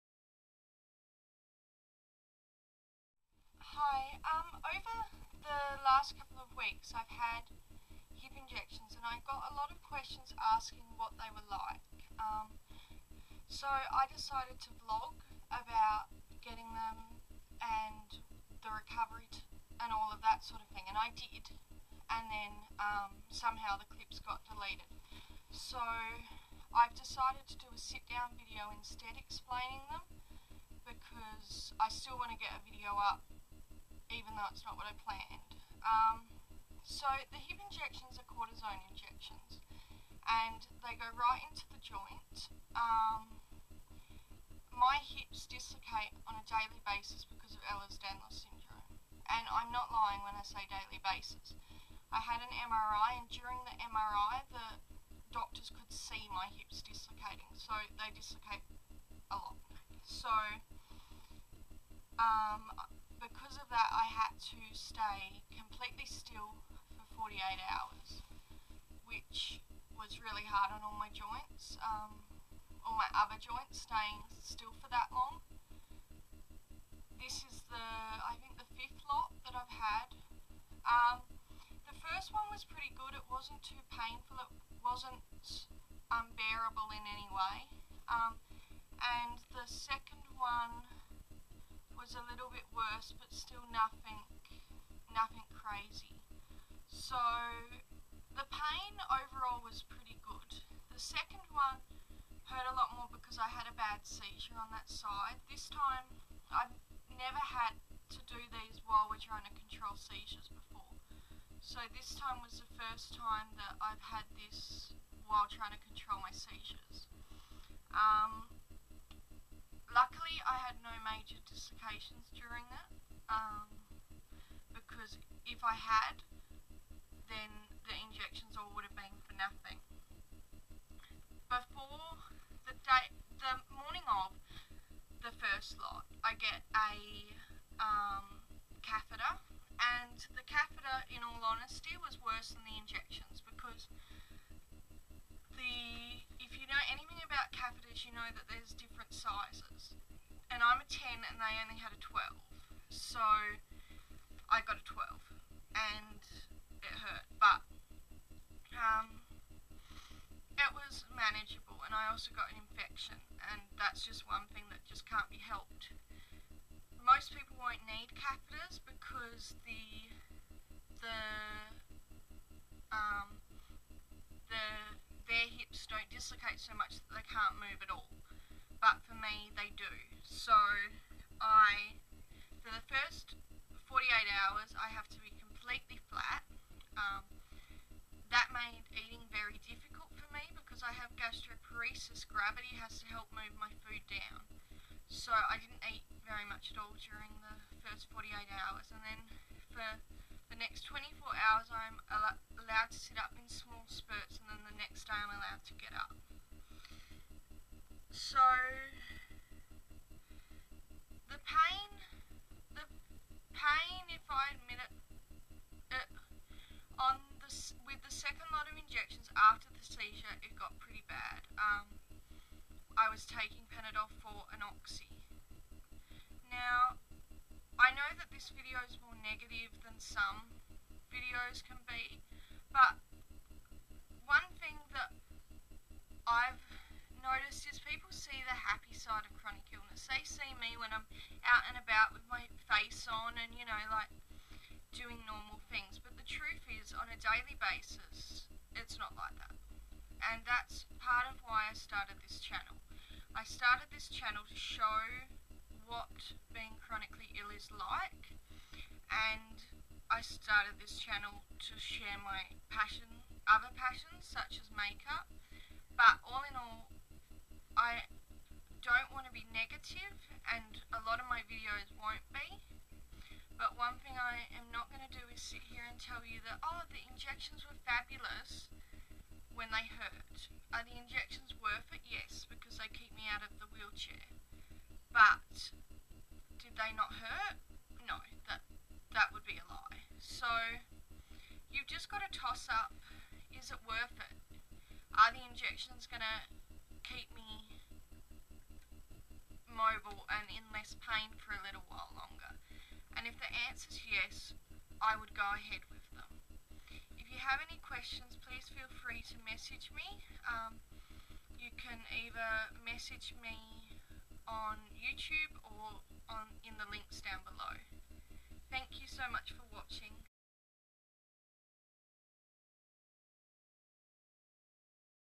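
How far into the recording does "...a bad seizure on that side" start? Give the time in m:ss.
1:43.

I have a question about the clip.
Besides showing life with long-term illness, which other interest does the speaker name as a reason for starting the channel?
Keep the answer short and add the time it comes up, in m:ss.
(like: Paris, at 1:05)
makeup, at 4:24.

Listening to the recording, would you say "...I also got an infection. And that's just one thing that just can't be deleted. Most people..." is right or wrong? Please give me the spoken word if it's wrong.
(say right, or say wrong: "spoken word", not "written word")
wrong: "helped", not "deleted".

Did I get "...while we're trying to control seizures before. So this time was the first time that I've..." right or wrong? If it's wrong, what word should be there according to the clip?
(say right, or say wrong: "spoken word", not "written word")
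right.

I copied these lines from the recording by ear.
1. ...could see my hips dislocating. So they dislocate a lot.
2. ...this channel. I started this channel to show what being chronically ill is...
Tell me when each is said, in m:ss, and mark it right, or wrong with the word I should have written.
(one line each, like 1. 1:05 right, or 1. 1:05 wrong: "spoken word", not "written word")
1. 0:55 right
2. 4:12 right.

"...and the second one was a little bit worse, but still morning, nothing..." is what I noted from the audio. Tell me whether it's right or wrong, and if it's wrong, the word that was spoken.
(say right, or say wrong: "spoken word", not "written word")
wrong: "nothing", not "morning".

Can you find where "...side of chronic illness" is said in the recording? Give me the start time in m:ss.
3:58.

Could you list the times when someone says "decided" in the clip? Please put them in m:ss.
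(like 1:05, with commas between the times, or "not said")
0:14, 0:26.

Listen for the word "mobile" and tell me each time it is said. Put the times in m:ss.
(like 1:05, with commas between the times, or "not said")
4:59.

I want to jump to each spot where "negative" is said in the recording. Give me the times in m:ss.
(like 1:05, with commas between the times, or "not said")
3:49, 4:29.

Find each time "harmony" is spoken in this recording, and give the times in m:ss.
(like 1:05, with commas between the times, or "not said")
not said.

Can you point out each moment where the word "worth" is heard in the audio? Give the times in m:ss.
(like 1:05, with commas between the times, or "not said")
4:41, 4:53.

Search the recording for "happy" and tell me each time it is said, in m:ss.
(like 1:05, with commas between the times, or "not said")
3:58.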